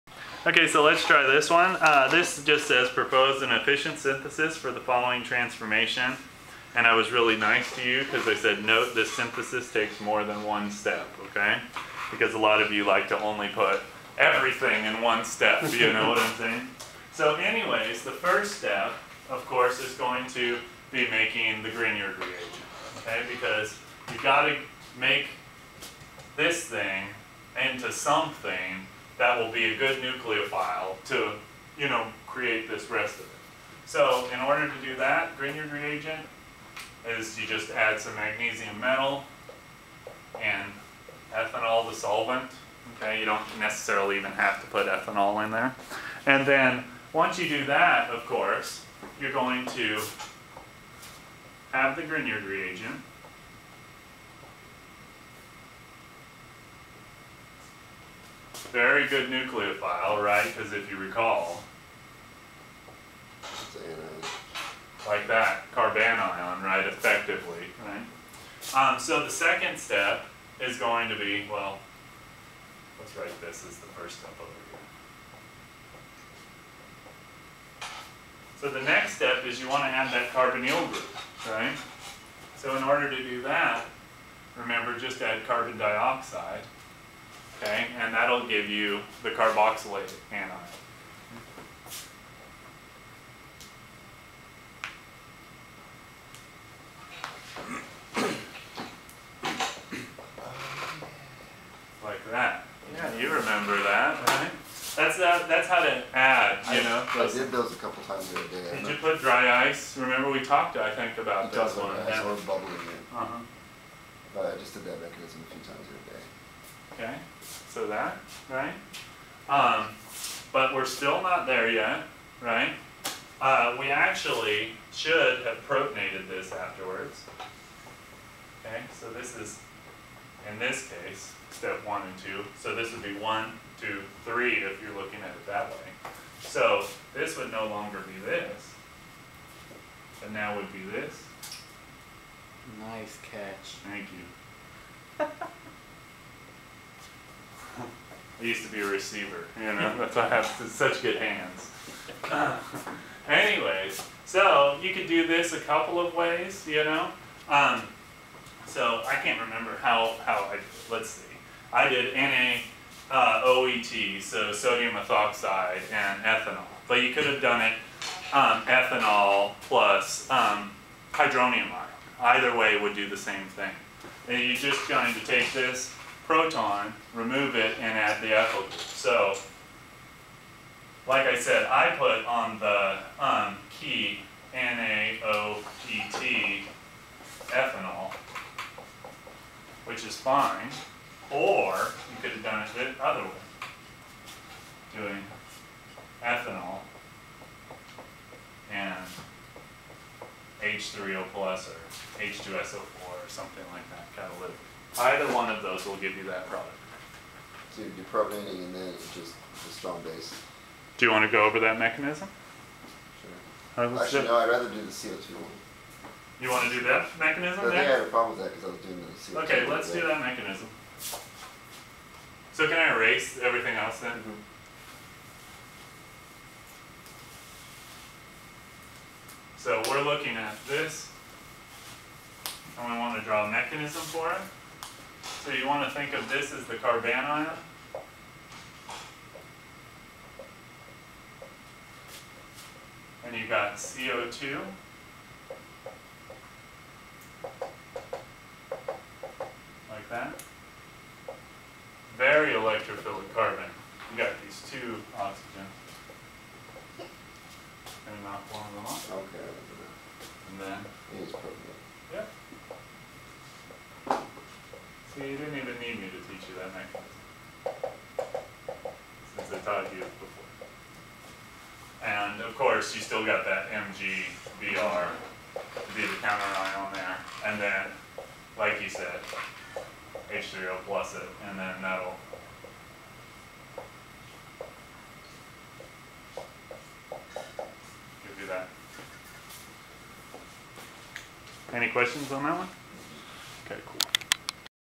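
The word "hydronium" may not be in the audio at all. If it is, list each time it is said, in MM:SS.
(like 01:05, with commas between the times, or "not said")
02:51.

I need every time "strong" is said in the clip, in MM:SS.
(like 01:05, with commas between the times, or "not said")
03:29.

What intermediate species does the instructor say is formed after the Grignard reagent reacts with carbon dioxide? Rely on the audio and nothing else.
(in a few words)
Carboxylate anion.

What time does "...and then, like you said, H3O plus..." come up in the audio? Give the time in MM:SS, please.
04:37.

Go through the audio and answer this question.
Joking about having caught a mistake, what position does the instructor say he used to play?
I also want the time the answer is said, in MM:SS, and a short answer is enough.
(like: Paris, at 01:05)
Receiver, at 02:28.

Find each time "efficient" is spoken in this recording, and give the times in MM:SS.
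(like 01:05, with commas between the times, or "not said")
00:03.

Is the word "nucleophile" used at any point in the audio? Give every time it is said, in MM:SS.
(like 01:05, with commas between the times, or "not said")
00:30, 00:59.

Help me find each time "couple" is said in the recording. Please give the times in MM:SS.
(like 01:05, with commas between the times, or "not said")
01:47, 02:35.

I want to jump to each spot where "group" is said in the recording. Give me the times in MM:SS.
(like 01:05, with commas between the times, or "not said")
01:20, 02:58.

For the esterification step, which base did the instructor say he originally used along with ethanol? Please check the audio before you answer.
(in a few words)
Sodium ethoxide.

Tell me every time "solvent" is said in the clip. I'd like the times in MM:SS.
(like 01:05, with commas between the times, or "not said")
00:41.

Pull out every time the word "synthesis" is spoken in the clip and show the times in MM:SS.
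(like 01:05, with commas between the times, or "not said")
00:03, 00:09.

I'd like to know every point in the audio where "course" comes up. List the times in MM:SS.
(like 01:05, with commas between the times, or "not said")
00:19, 00:48, 04:32.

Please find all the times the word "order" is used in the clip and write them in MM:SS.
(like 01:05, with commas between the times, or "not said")
00:34, 01:22.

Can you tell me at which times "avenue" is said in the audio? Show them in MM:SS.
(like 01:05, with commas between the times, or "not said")
not said.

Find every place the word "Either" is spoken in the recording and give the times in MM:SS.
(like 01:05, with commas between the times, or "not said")
02:52, 03:24.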